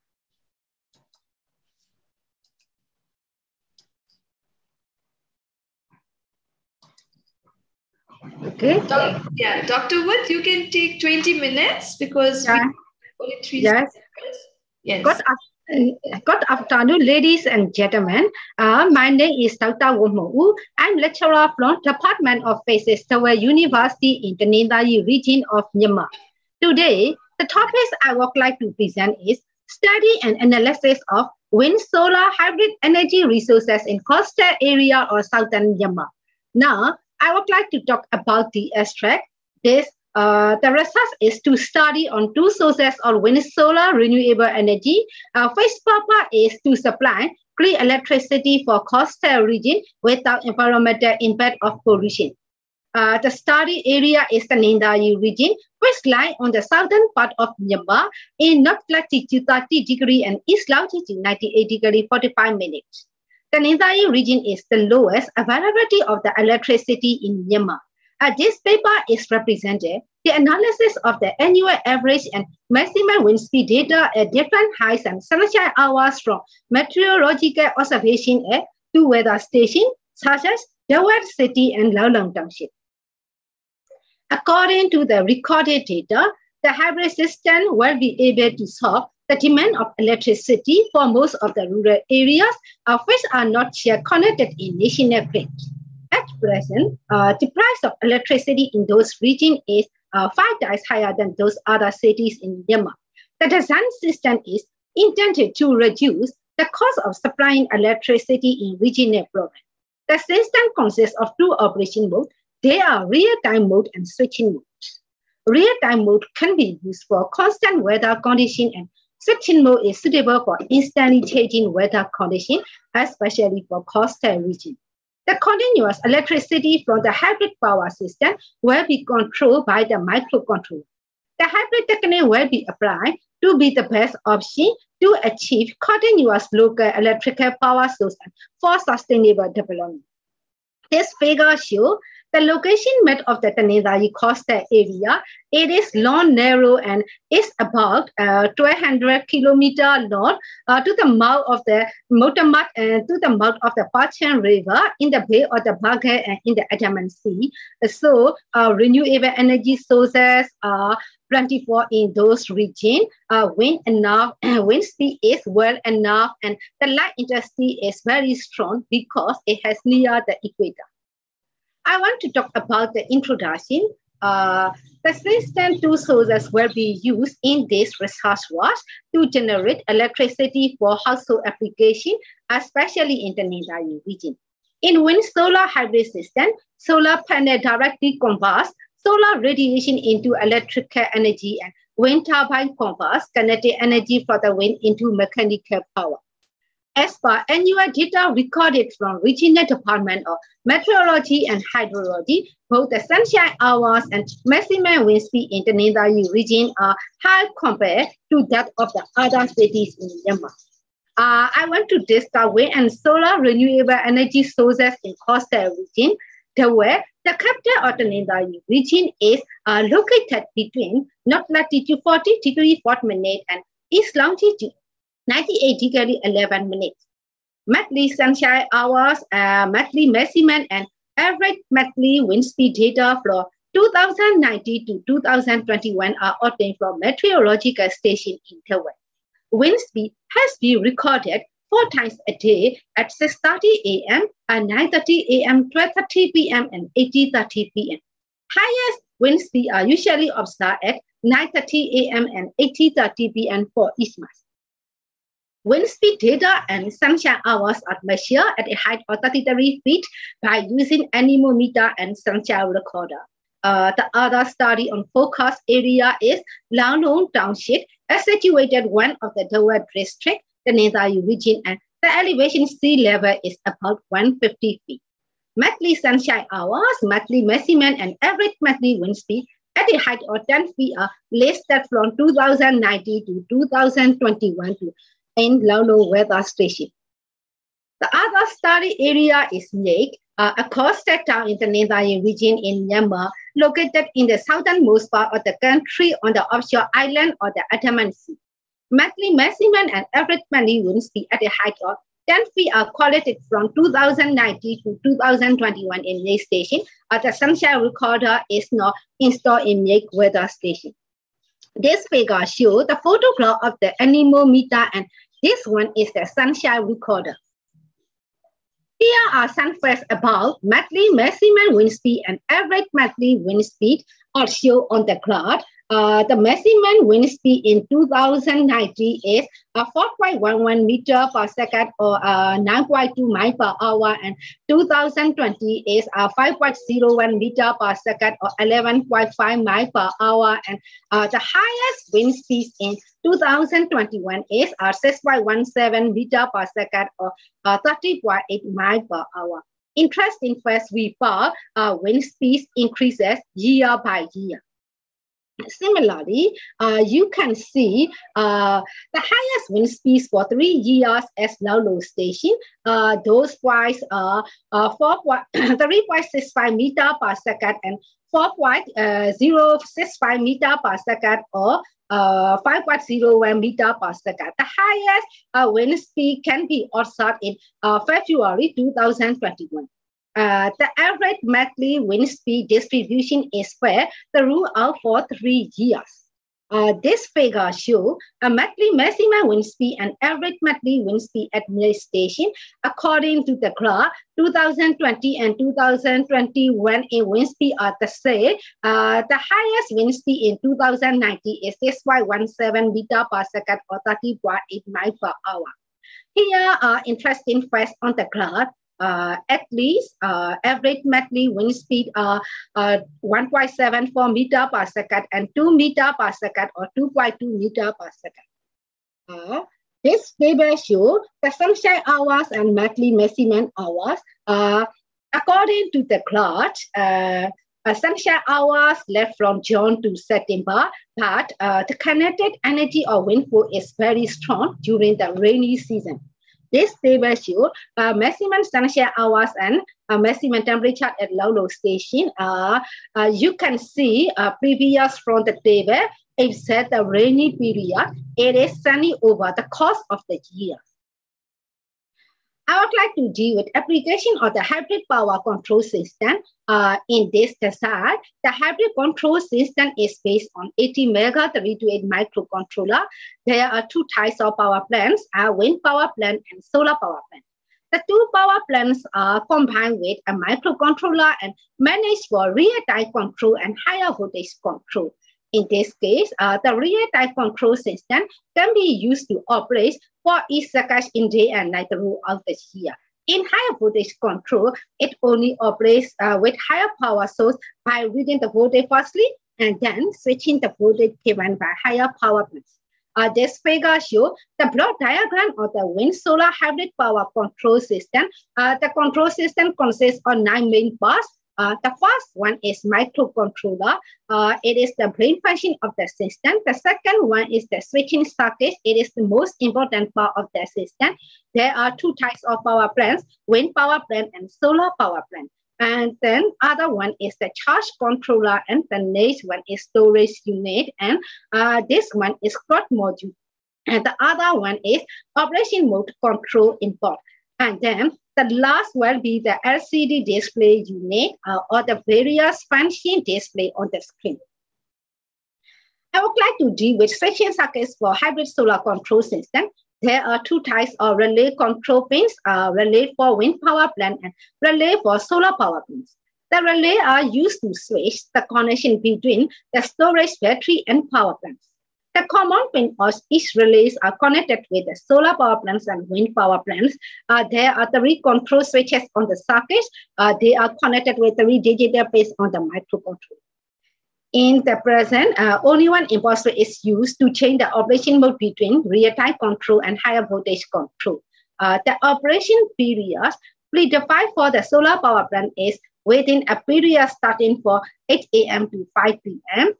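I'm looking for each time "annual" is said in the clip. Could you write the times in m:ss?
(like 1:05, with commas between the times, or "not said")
1:11, 3:17.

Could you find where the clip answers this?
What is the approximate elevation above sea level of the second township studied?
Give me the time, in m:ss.
4:34.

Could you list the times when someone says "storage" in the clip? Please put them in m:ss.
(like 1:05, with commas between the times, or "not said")
8:39, 9:09.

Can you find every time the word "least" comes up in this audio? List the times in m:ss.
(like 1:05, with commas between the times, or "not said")
6:49.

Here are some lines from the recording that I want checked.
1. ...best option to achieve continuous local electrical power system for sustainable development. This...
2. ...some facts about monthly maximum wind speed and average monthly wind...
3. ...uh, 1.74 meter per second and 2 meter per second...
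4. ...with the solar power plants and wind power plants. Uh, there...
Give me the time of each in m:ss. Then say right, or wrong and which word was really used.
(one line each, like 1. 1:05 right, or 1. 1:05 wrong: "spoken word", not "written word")
1. 2:13 right
2. 5:19 right
3. 6:52 right
4. 9:14 right.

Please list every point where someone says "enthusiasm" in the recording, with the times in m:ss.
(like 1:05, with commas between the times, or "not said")
not said.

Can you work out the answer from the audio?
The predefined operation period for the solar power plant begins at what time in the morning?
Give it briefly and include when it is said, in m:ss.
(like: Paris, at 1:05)
8 a.m., at 9:38.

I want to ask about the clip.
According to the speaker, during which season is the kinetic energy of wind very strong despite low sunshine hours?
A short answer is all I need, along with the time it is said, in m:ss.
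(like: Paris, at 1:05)
Rainy season, at 7:15.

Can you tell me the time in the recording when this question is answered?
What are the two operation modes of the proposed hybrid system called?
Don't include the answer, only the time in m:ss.
1:53.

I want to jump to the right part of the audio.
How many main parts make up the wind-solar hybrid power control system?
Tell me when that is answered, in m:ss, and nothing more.
8:20.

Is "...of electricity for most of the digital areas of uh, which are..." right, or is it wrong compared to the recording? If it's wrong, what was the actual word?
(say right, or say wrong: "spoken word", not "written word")
wrong: "rural", not "digital".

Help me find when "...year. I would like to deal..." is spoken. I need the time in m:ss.
7:30.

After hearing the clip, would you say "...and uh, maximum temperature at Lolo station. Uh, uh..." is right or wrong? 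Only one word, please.
right.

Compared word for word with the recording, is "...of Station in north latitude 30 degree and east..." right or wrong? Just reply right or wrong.
wrong.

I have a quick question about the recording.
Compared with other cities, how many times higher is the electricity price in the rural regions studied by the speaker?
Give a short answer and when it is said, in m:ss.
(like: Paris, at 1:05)
5 times, at 1:40.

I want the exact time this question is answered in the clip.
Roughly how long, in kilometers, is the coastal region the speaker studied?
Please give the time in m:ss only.
2:28.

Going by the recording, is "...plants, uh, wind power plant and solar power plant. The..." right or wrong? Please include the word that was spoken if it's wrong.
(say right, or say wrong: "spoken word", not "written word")
right.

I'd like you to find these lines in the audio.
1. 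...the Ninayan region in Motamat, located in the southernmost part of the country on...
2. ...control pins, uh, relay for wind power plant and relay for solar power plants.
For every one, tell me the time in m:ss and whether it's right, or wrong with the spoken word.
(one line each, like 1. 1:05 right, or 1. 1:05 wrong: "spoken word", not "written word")
1. 4:51 wrong: "Myanmar", not "Motamat"
2. 9:01 right.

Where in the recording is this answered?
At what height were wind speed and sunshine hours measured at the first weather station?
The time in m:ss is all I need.
4:19.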